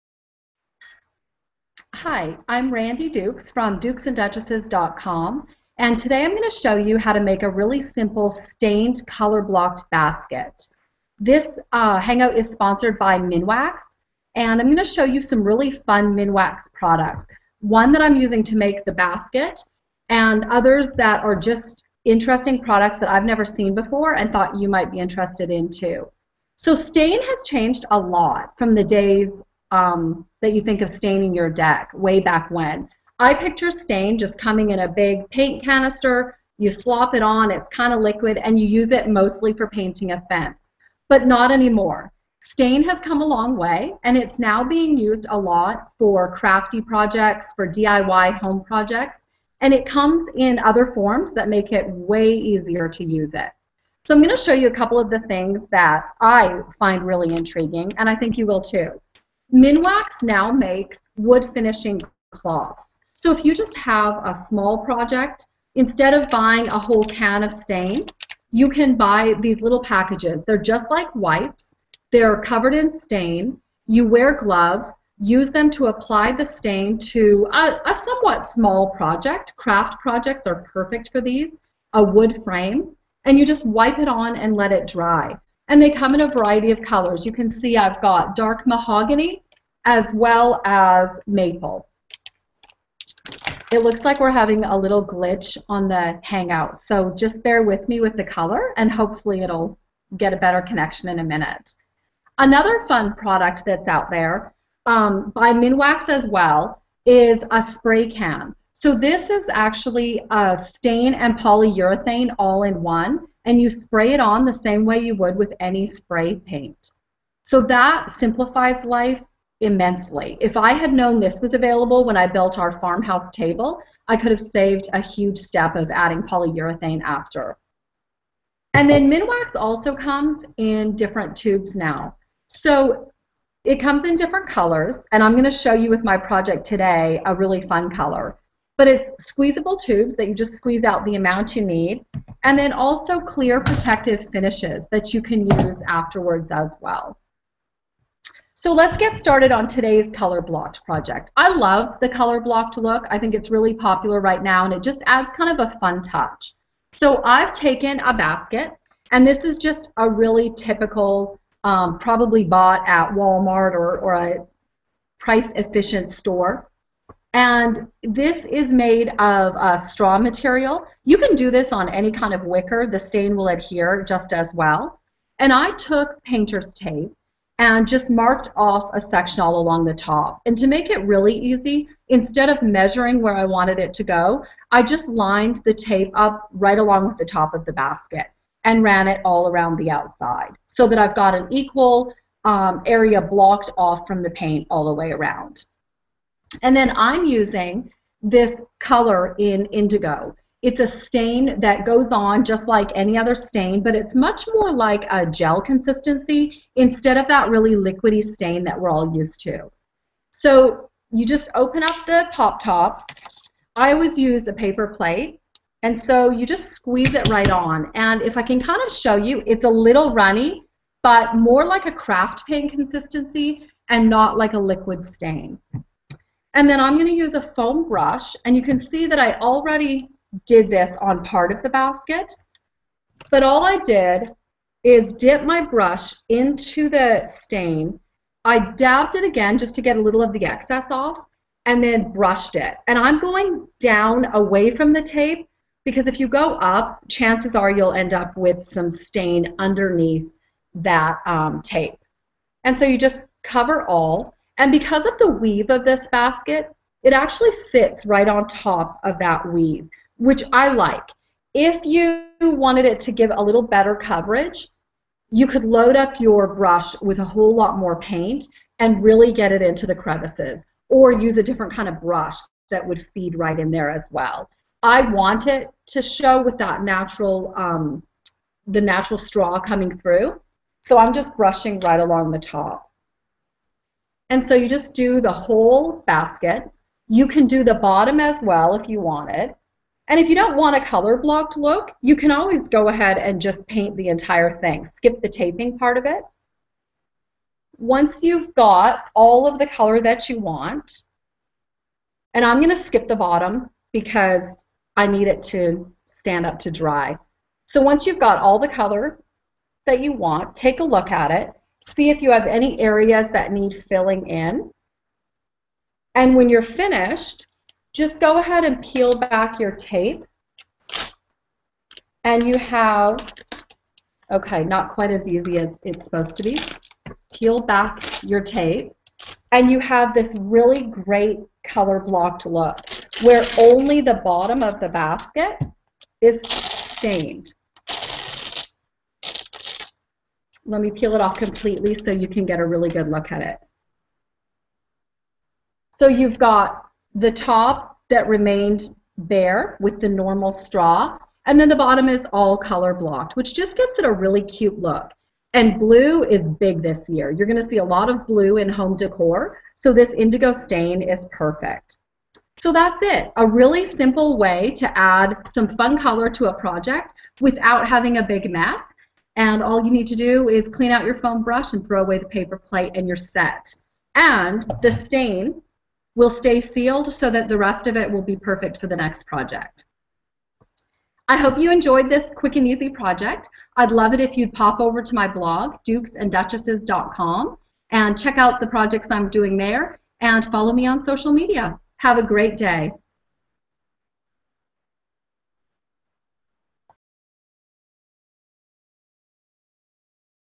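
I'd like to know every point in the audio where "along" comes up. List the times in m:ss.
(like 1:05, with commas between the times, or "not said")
2:59, 3:06, 4:41.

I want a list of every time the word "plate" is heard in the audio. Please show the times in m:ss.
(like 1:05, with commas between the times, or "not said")
3:34, 6:12.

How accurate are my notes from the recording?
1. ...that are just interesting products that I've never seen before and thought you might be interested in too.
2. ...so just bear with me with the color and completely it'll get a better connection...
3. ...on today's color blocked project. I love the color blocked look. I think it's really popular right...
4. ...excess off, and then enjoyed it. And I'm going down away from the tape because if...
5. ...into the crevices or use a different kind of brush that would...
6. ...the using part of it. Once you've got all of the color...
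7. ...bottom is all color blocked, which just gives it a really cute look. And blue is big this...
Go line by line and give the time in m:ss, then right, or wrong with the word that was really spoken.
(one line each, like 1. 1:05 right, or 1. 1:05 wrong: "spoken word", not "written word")
1. 0:20 right
2. 1:36 wrong: "hopefully", not "completely"
3. 2:29 right
4. 4:00 wrong: "brushed", not "enjoyed"
5. 4:29 right
6. 4:55 wrong: "taping", not "using"
7. 5:51 right.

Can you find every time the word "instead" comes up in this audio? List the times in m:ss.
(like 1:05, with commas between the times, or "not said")
1:05, 3:02, 3:26.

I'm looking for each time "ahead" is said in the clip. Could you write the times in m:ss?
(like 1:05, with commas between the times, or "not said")
4:52, 5:18.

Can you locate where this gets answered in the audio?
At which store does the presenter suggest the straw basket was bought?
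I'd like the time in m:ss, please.
2:43.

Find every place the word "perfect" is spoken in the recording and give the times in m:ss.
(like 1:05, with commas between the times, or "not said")
1:20, 6:01, 6:18.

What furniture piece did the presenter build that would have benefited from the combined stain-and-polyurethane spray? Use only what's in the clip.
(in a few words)
farmhouse table.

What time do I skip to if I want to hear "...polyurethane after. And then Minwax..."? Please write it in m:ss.
2:06.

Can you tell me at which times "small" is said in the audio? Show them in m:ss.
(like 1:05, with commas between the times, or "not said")
1:04, 1:18.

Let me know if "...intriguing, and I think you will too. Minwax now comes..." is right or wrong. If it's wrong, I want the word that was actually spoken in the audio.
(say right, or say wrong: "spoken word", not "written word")
wrong: "makes", not "comes".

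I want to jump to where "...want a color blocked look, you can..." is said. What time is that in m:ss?
4:50.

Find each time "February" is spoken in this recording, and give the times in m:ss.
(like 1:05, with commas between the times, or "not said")
not said.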